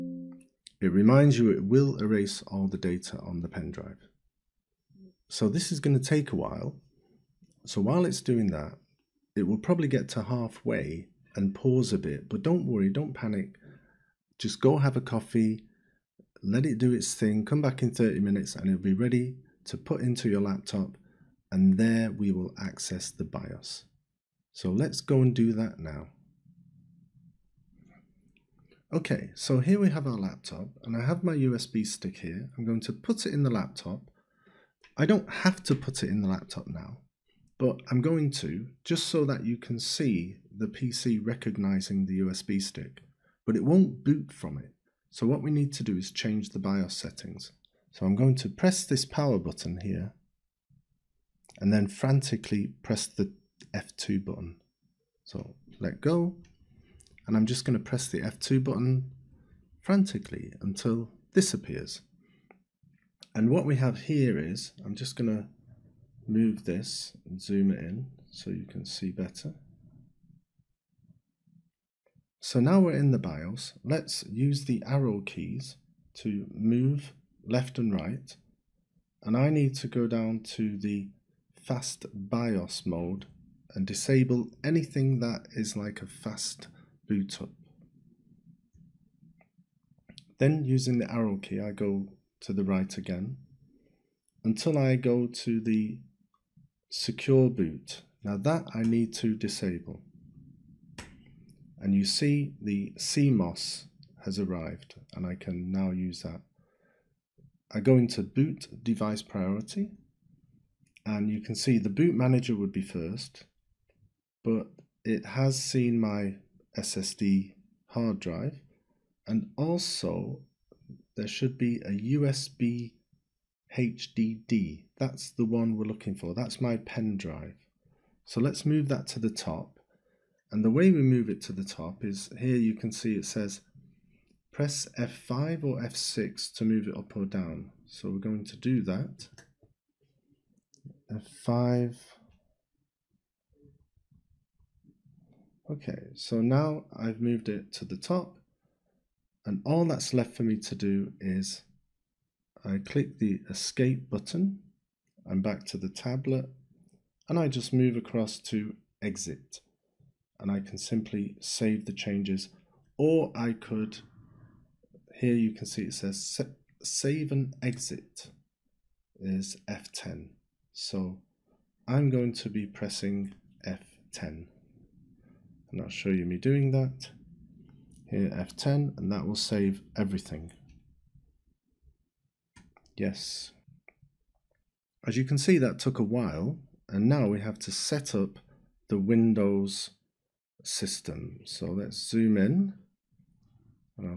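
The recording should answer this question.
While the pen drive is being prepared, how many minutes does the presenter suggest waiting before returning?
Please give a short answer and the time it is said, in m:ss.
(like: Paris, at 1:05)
30, at 0:17.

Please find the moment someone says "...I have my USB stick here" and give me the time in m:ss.
0:30.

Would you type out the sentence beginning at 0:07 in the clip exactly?
So while it's doing that, it will probably get to halfway and pause a bit, but don't worry, don't panic.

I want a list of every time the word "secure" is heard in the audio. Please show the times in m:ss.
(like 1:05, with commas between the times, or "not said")
1:36.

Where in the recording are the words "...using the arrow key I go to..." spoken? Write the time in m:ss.
1:30.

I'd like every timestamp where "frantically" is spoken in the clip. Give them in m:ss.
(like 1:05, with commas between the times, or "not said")
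0:51, 0:59.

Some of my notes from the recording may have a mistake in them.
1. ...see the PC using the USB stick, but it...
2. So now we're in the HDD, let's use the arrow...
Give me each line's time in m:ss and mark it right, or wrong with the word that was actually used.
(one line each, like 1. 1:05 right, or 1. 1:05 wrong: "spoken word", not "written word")
1. 0:39 wrong: "recognizing", not "using"
2. 1:12 wrong: "BIOS", not "HDD".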